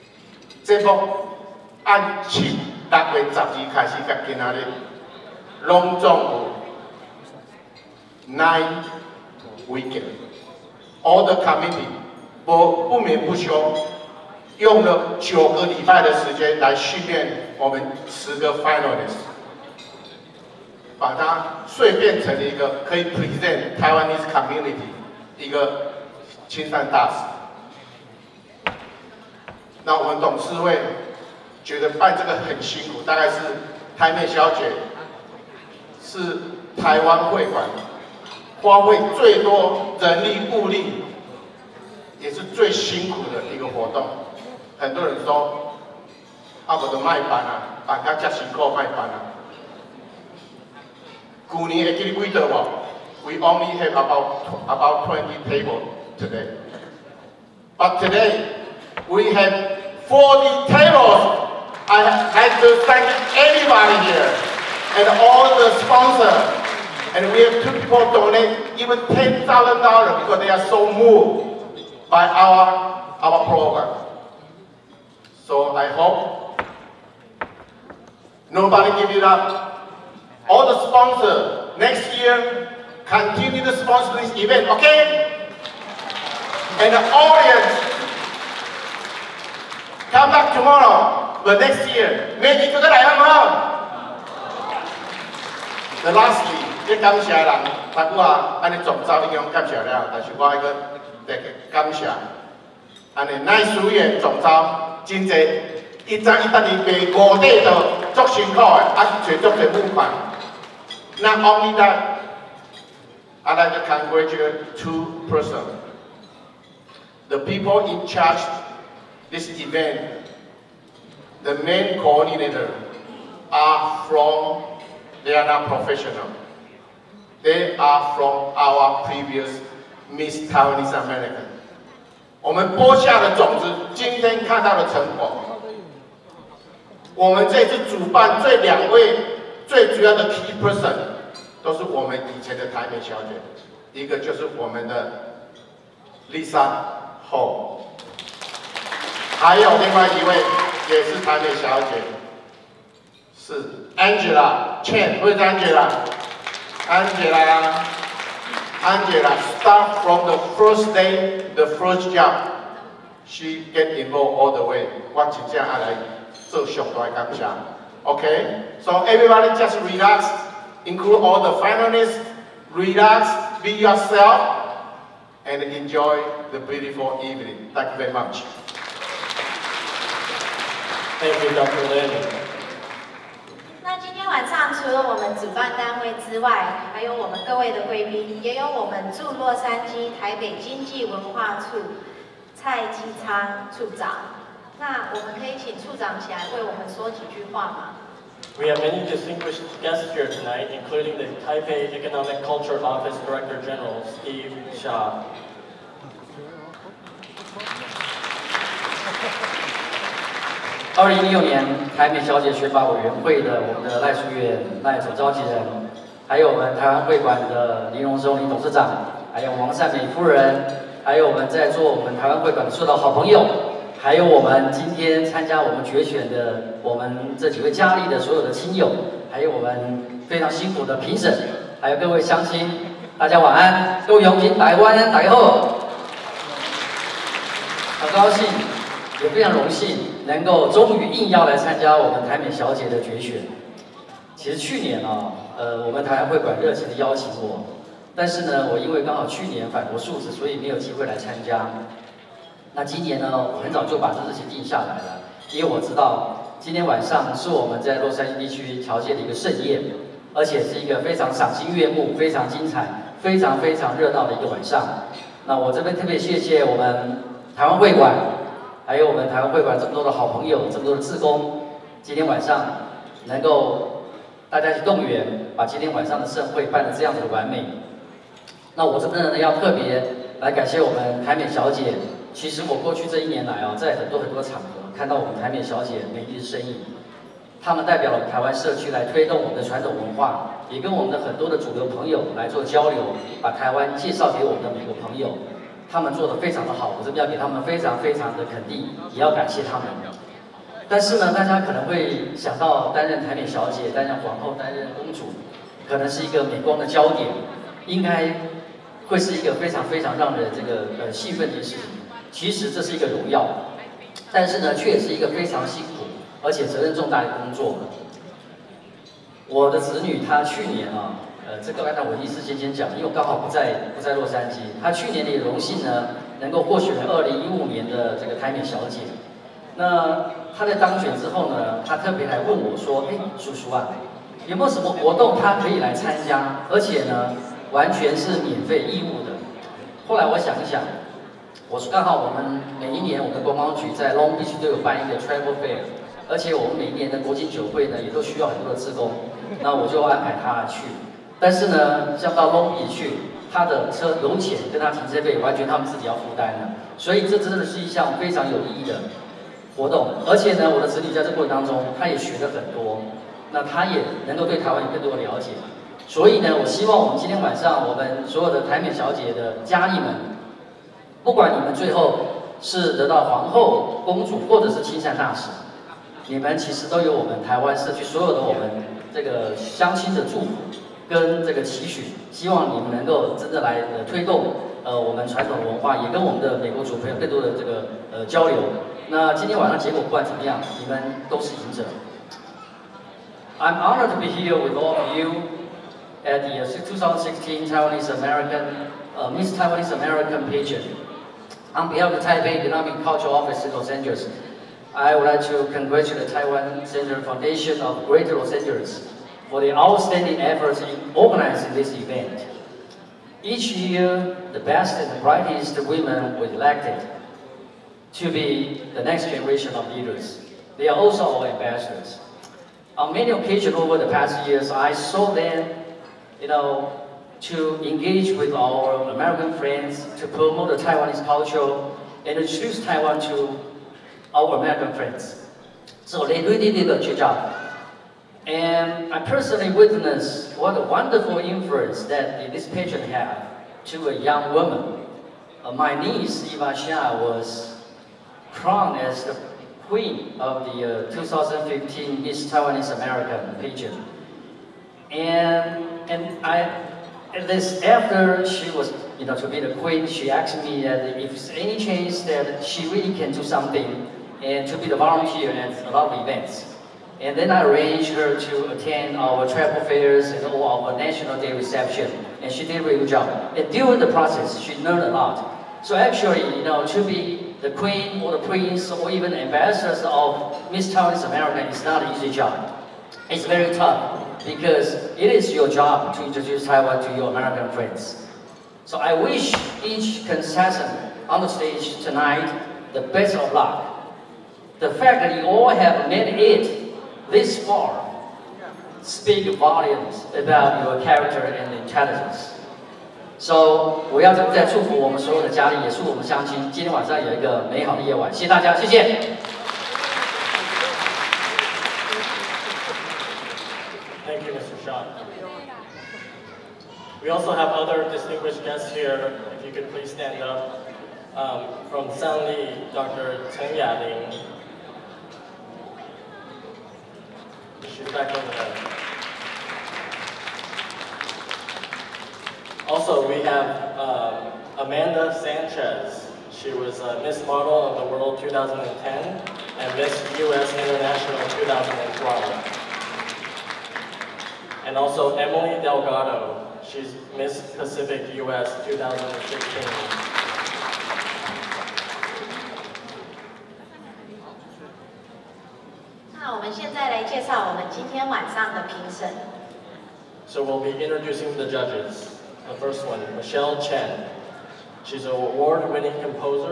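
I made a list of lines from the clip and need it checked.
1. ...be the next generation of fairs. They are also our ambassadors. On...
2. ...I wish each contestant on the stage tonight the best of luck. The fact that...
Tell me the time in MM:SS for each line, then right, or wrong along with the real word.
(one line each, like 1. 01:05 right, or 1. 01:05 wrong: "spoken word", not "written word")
1. 06:58 wrong: "leaders", not "fairs"
2. 08:08 right.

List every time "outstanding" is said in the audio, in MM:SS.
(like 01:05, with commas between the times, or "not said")
06:49.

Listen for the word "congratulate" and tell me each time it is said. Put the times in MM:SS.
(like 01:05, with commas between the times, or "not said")
01:53, 06:45.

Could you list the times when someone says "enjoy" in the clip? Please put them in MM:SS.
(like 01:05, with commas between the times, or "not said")
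02:55.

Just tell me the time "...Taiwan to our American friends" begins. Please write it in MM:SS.
07:12.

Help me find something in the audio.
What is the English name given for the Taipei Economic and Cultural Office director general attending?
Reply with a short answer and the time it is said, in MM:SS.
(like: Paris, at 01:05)
Steve Shaw, at 03:24.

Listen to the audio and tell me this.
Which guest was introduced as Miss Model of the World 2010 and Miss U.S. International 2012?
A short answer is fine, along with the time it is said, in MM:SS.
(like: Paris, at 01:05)
Amanda Sanchez, at 08:54.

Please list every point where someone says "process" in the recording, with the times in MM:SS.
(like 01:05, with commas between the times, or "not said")
07:54.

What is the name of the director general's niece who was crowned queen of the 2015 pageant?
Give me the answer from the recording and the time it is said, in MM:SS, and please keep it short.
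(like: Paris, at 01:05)
Eva Xia, at 07:26.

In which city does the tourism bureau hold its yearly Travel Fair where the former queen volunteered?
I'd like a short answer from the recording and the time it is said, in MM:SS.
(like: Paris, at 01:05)
Long Beach, at 05:44.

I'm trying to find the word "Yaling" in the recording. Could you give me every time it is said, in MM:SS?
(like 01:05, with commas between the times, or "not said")
08:43.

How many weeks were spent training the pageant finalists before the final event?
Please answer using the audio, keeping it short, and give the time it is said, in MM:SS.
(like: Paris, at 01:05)
9, at 00:15.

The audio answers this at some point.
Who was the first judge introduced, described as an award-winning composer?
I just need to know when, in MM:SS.
09:23.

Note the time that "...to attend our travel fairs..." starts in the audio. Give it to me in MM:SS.
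07:48.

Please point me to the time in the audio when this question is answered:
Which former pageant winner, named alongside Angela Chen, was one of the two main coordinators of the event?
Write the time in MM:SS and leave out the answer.
02:26.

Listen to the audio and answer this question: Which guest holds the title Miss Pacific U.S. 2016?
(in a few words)
Emily Delgado.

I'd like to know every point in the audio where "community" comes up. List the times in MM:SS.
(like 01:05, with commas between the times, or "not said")
00:11, 00:24.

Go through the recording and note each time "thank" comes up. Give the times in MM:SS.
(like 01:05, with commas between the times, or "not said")
01:02, 02:57.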